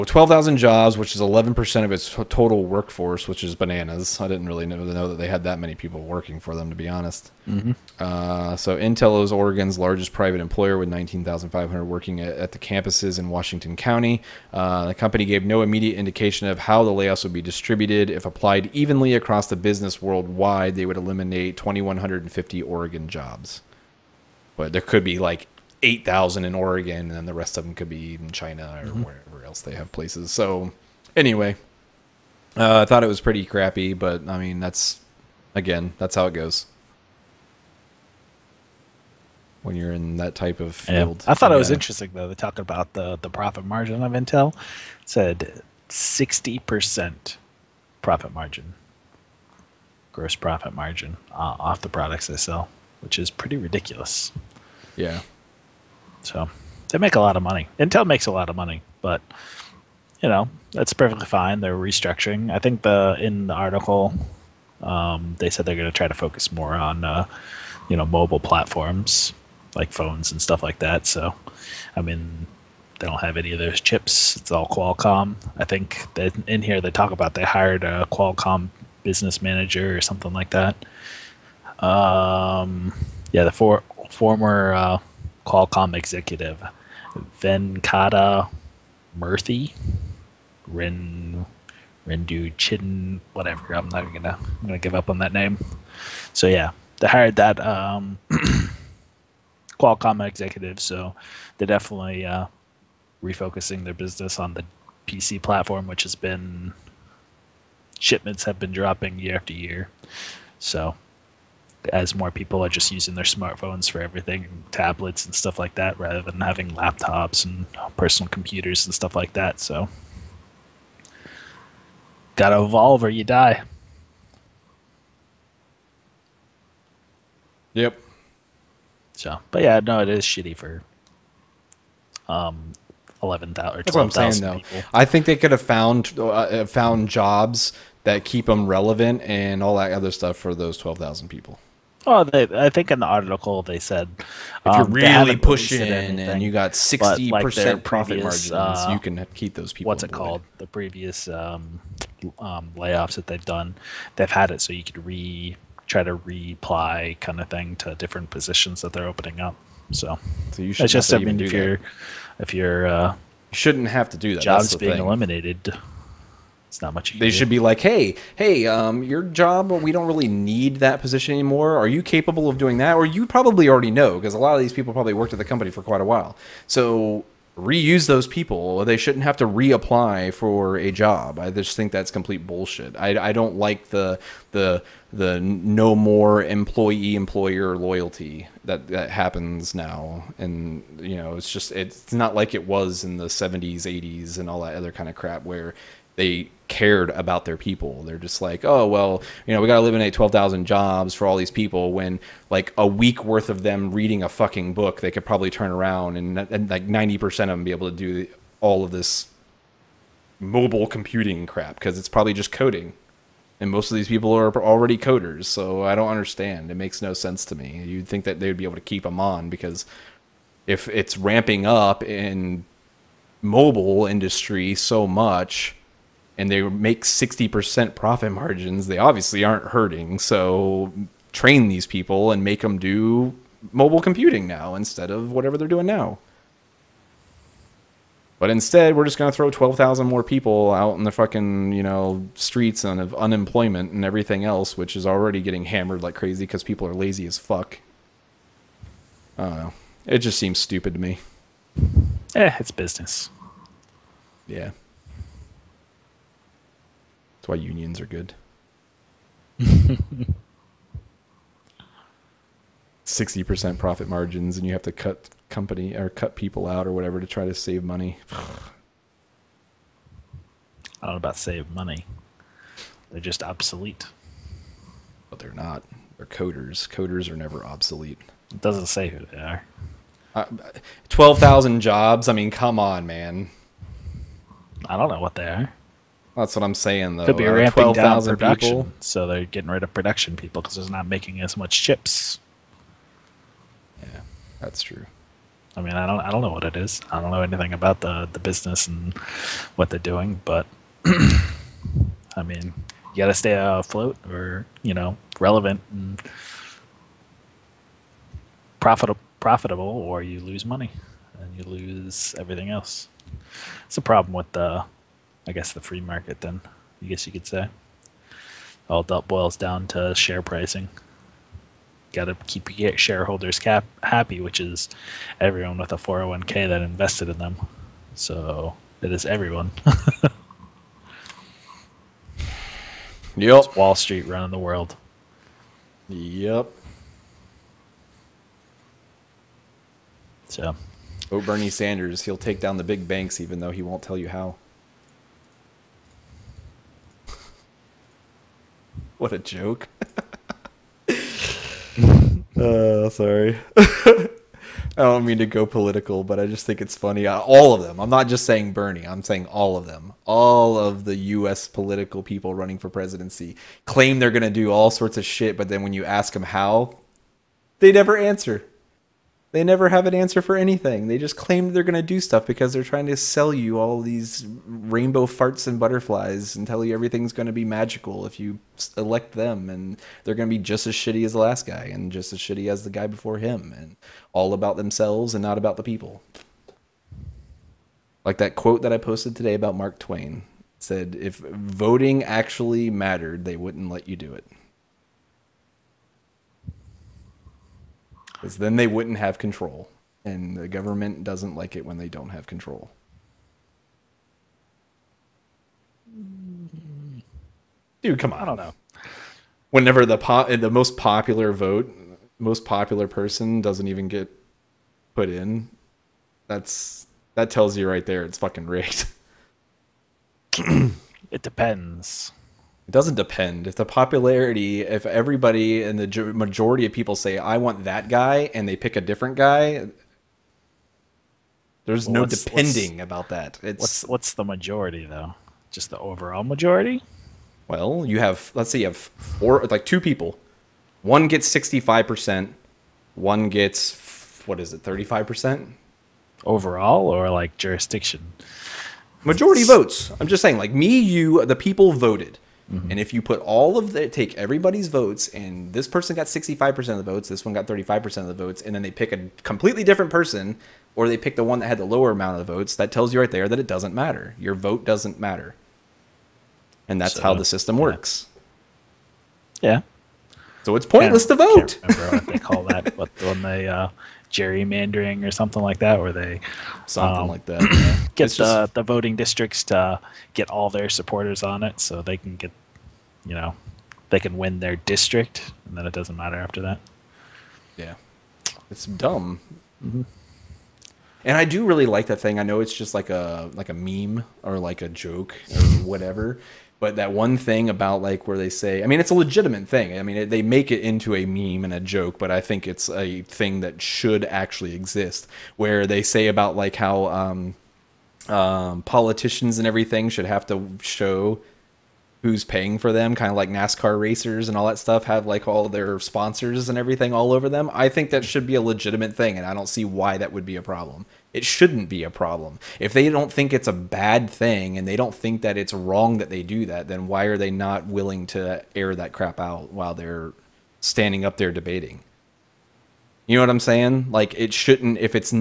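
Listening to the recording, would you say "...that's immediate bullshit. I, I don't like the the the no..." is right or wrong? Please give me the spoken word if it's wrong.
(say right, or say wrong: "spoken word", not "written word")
wrong: "complete", not "immediate".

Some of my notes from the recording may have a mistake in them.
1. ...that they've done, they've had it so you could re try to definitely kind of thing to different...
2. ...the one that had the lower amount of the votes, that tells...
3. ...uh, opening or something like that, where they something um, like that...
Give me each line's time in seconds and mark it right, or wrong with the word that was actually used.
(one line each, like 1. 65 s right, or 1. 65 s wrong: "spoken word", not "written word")
1. 153 s wrong: "reply", not "definitely"
2. 461 s right
3. 473 s wrong: "gerrymandering", not "opening".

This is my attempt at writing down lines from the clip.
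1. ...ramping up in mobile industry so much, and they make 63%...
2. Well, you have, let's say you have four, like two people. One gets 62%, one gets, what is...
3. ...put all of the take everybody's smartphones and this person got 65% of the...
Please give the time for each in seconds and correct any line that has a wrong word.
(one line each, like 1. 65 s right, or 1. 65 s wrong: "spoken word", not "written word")
1. 221 s wrong: "60", not "63"
2. 437 s wrong: "65", not "62"
3. 453 s wrong: "votes", not "smartphones".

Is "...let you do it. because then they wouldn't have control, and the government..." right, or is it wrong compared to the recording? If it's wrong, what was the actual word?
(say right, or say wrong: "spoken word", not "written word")
right.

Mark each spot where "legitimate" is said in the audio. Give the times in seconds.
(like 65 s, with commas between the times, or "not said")
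499 s, 518 s.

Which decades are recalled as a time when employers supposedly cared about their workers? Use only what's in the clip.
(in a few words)
70s and 80s.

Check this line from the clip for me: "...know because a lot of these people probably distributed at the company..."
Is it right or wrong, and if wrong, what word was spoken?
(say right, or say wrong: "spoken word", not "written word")
wrong: "worked", not "distributed".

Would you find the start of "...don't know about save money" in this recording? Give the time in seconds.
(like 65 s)
271 s.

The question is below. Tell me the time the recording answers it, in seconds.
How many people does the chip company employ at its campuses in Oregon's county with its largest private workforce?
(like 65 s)
10 s.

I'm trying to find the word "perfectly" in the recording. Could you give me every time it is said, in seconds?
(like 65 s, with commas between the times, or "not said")
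60 s.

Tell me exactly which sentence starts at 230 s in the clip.
So train these people and make them do mobile computing now instead of whatever they're doing now.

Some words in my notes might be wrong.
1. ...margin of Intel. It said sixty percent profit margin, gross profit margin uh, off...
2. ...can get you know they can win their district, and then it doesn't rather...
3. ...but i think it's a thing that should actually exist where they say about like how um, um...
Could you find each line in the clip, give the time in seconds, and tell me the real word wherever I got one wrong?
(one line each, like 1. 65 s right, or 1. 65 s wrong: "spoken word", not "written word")
1. 43 s right
2. 482 s wrong: "matter", not "rather"
3. 502 s right.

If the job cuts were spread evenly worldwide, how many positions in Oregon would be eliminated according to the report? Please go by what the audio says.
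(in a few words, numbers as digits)
2,150.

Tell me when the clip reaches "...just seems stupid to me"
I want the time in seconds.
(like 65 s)
250 s.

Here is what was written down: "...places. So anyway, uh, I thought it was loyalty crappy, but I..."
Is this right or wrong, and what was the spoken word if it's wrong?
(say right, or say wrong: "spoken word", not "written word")
wrong: "pretty", not "loyalty".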